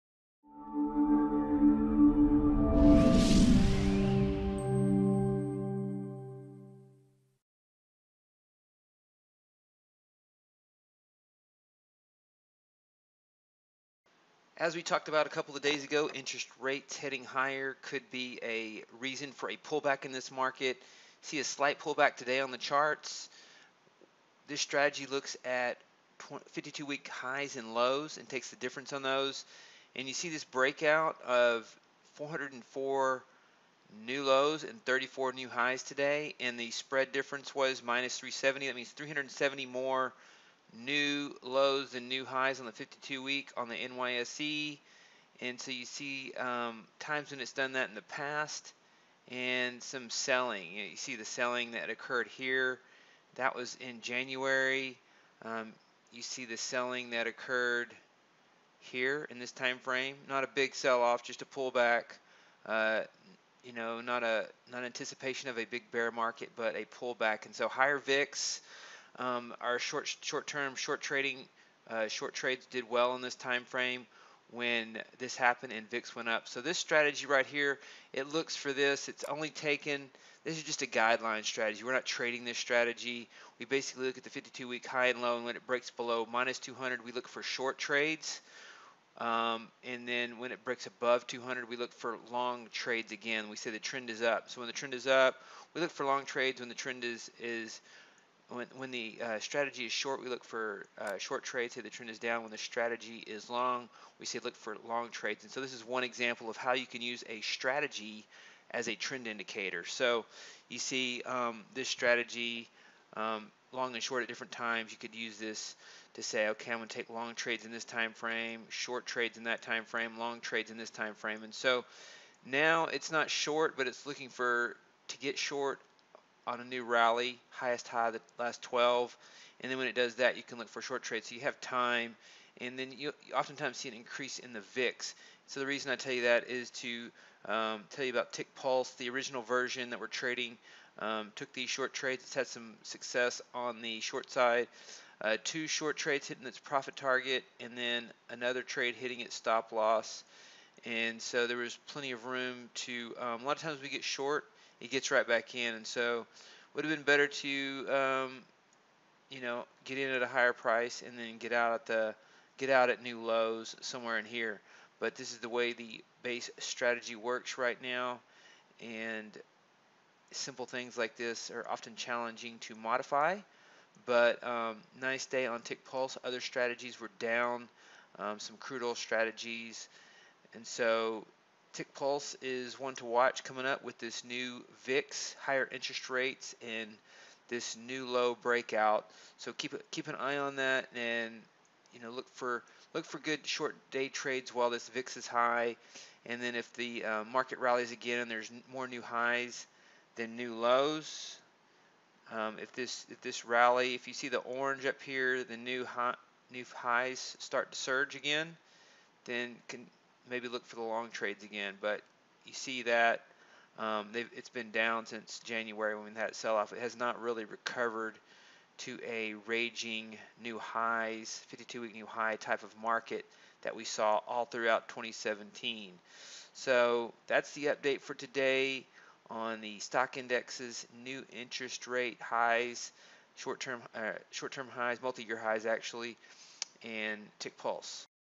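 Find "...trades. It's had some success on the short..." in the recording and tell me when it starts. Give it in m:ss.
2:21.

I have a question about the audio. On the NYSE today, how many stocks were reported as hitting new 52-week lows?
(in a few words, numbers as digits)
404.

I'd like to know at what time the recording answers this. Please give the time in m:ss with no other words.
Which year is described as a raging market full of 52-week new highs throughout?
3:44.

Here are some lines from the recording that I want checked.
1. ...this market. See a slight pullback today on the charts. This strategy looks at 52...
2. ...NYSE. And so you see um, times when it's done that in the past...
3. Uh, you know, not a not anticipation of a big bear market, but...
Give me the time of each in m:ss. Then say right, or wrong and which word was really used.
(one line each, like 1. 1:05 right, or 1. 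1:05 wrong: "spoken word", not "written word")
1. 0:20 right
2. 0:43 right
3. 1:02 right.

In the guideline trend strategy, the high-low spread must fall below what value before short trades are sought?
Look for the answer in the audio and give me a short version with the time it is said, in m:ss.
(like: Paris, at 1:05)
-200, at 1:26.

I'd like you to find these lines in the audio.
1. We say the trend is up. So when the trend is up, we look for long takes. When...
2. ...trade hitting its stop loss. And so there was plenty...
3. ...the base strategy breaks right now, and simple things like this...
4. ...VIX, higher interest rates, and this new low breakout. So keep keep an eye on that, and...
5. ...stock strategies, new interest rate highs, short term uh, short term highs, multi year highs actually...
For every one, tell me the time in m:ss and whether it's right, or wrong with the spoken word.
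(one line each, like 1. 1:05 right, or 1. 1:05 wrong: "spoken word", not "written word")
1. 1:33 wrong: "trades", not "takes"
2. 2:28 right
3. 2:45 wrong: "works", not "breaks"
4. 3:04 right
5. 3:49 wrong: "indexes", not "strategies".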